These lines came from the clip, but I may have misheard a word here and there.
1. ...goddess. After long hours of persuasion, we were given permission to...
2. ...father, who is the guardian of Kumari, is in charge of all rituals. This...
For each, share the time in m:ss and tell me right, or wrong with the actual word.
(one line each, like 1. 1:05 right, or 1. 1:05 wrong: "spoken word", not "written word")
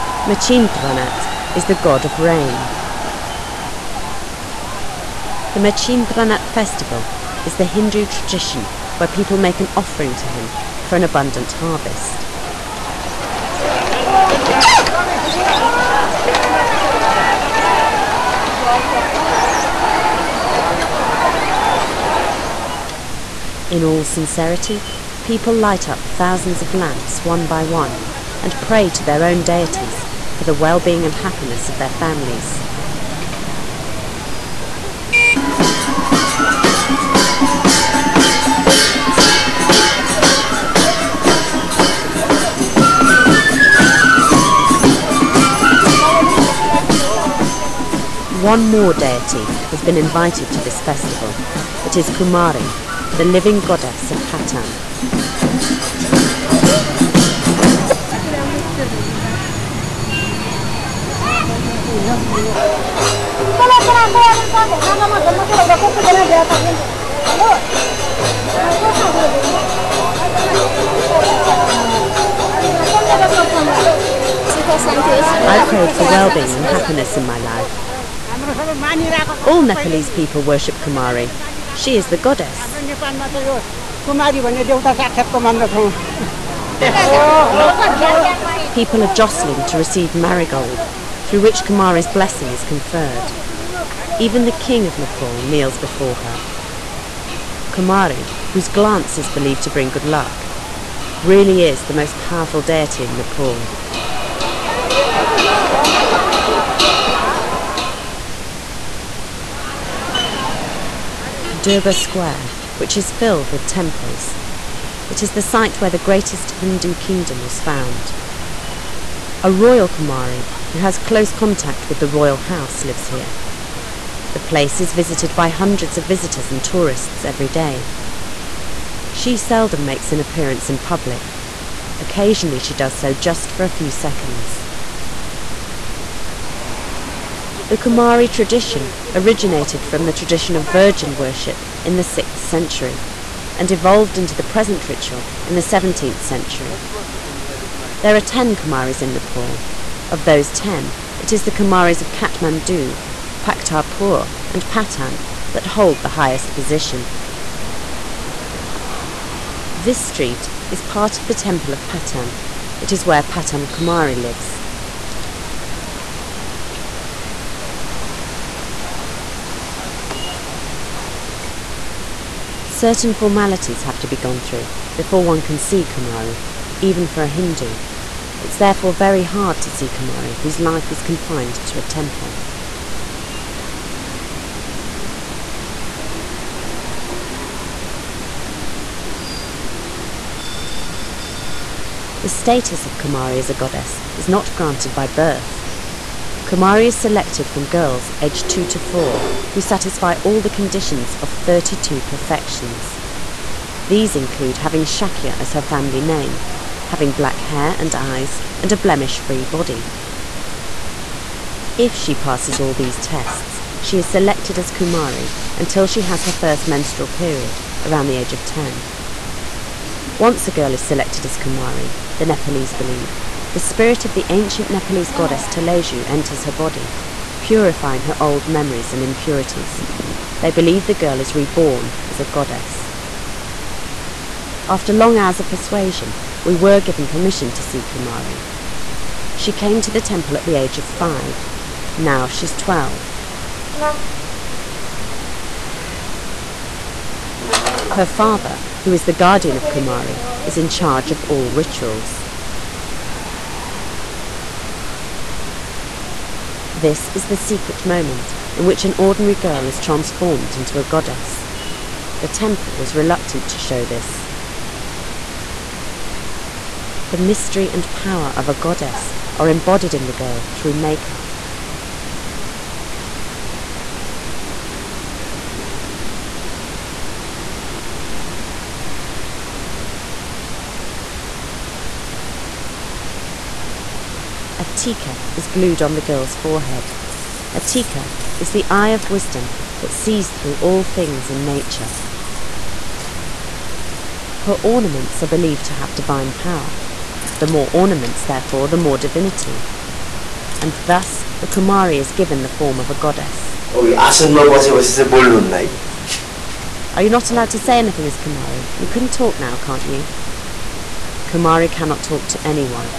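1. 3:52 right
2. 4:08 right.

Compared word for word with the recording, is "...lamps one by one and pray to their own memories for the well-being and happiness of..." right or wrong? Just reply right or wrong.
wrong.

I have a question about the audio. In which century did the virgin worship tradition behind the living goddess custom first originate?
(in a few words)
6th century.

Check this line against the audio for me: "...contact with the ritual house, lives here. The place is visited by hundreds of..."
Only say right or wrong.
wrong.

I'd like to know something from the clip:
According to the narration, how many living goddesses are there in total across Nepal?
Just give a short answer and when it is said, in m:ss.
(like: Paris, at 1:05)
10, at 2:28.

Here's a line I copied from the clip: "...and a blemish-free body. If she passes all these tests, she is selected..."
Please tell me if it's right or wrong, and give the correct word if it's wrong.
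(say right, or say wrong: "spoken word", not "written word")
right.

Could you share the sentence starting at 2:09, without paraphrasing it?
She seldom makes an appearance in public.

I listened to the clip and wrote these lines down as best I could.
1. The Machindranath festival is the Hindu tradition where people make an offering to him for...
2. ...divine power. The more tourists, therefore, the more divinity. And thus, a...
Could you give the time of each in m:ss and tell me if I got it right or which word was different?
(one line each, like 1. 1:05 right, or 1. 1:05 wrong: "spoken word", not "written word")
1. 0:05 right
2. 4:55 wrong: "ornaments", not "tourists".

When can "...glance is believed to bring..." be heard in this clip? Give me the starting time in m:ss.
1:38.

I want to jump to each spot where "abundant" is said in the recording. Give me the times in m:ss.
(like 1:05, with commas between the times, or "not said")
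0:11.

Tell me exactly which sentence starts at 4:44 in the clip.
tika is glued on the girl's forehead.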